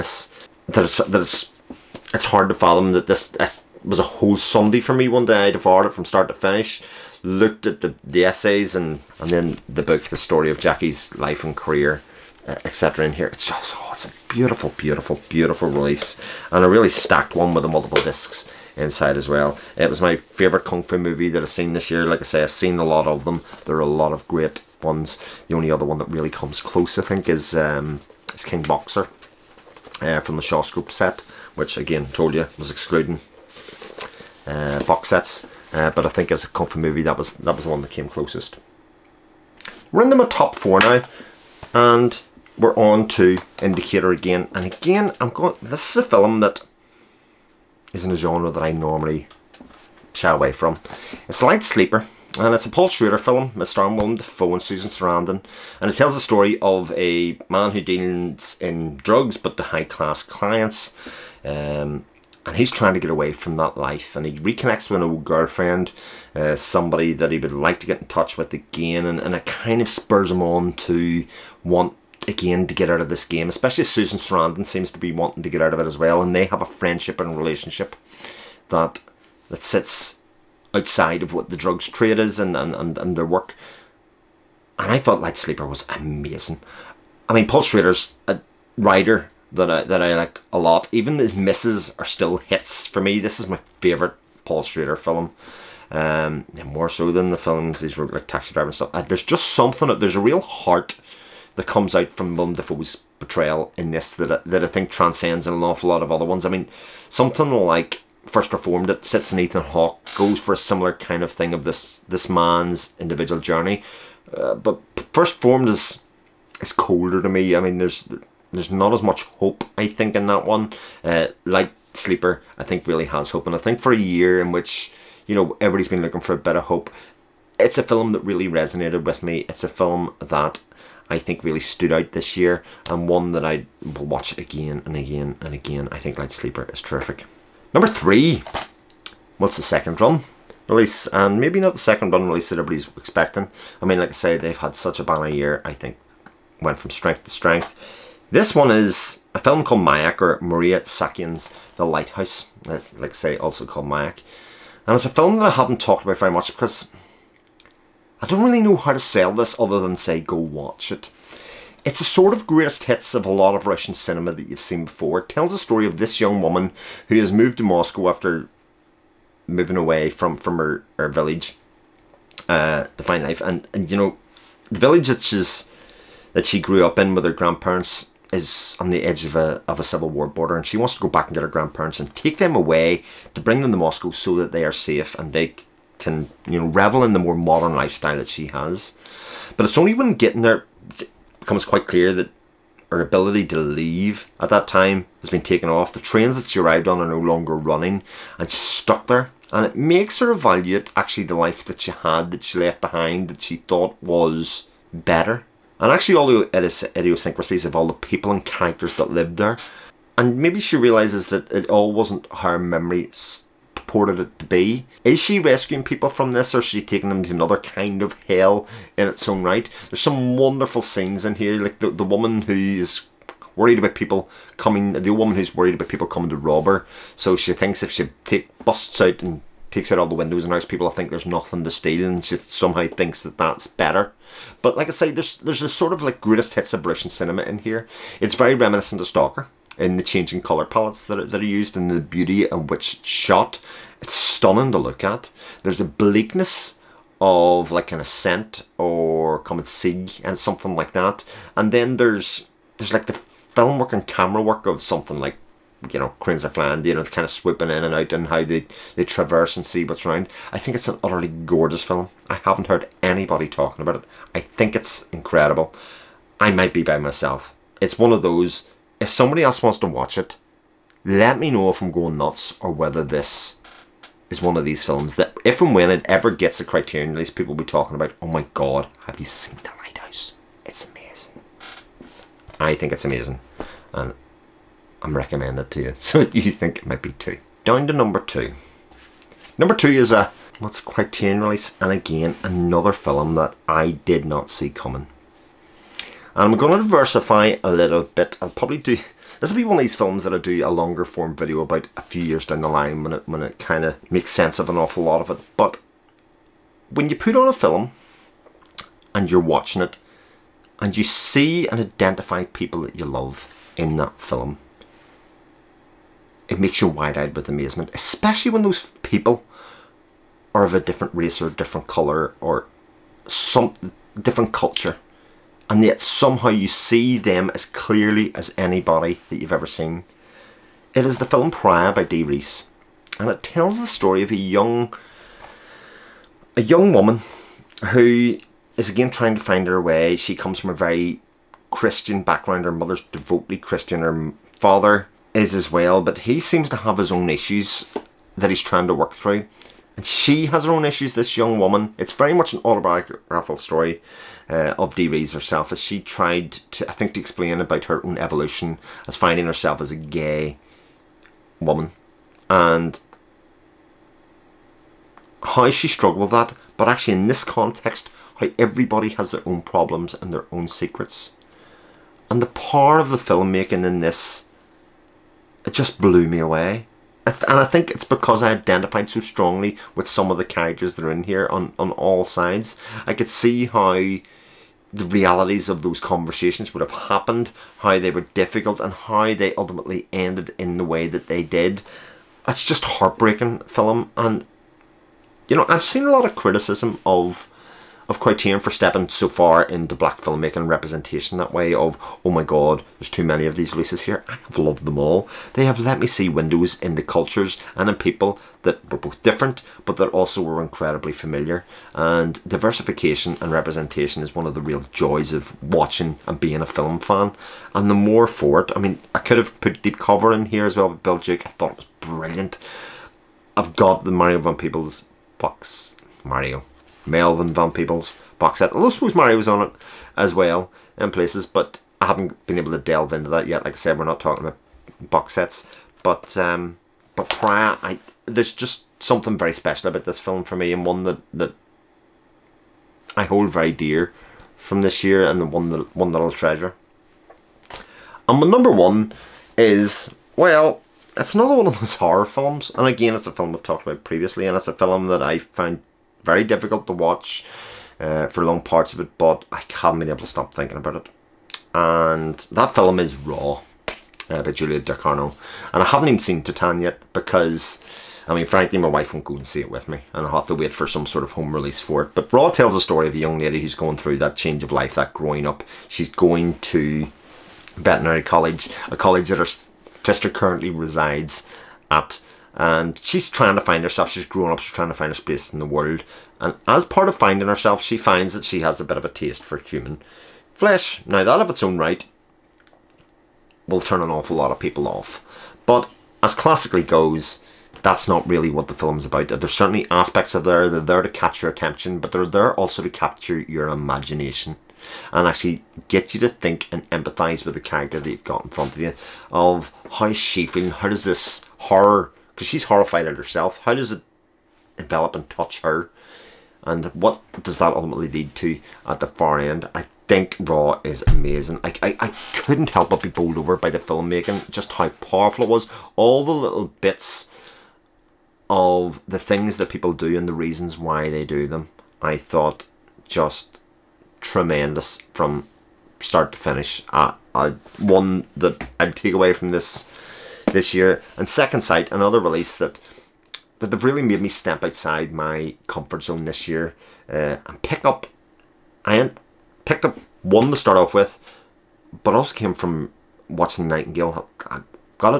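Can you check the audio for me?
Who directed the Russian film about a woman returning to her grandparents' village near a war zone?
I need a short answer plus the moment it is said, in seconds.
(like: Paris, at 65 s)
Maria Saakyan, at 150 s.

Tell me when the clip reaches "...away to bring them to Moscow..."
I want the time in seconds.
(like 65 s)
182 s.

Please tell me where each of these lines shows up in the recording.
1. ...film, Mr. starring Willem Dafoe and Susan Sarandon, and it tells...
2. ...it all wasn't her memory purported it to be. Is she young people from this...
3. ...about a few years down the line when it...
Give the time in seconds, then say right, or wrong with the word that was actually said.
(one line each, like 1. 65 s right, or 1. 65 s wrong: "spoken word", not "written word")
1. 53 s right
2. 211 s wrong: "rescuing", not "young"
3. 301 s right.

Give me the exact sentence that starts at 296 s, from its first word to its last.
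And I'm going to diversify a little bit.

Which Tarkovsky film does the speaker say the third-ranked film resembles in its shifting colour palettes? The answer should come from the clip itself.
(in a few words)
Stalker.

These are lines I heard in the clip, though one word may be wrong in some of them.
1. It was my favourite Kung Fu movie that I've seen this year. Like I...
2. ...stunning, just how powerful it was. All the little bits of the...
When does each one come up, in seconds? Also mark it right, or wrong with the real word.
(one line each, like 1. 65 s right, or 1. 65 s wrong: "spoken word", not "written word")
1. 19 s right
2. 523 s wrong: "filmmaking", not "stunning".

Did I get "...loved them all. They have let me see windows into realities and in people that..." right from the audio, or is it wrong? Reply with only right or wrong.
wrong.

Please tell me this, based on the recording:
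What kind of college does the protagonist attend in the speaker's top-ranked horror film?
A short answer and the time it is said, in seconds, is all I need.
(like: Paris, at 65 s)
veterinary college, at 477 s.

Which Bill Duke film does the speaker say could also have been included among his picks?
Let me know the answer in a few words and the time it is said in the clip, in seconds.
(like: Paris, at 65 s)
Deep Cover, at 419 s.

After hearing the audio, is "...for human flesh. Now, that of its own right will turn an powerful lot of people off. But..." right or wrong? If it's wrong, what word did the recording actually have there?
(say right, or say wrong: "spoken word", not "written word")
wrong: "awful", not "powerful".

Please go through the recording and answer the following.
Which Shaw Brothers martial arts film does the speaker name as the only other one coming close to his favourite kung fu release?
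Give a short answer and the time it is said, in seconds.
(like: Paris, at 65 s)
King Boxer, at 28 s.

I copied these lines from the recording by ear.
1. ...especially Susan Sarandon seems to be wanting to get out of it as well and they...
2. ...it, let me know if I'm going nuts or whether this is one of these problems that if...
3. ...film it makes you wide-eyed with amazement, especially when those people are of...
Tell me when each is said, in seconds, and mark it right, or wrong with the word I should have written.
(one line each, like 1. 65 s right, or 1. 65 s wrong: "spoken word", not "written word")
1. 73 s right
2. 270 s wrong: "films", not "problems"
3. 314 s right.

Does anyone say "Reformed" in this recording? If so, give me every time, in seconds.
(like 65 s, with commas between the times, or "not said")
108 s, 115 s.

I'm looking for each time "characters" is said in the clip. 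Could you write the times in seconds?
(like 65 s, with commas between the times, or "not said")
208 s, 380 s, 507 s.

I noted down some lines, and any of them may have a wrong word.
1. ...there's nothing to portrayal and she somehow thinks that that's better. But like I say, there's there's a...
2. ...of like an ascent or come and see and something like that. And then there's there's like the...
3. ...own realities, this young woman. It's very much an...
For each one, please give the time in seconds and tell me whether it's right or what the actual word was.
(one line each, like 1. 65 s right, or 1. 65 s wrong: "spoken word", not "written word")
1. 231 s wrong: "steal", not "portrayal"
2. 247 s right
3. 350 s wrong: "issues", not "realities".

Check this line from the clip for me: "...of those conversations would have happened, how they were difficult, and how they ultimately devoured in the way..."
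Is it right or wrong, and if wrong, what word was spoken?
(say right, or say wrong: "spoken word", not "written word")
wrong: "ended", not "devoured".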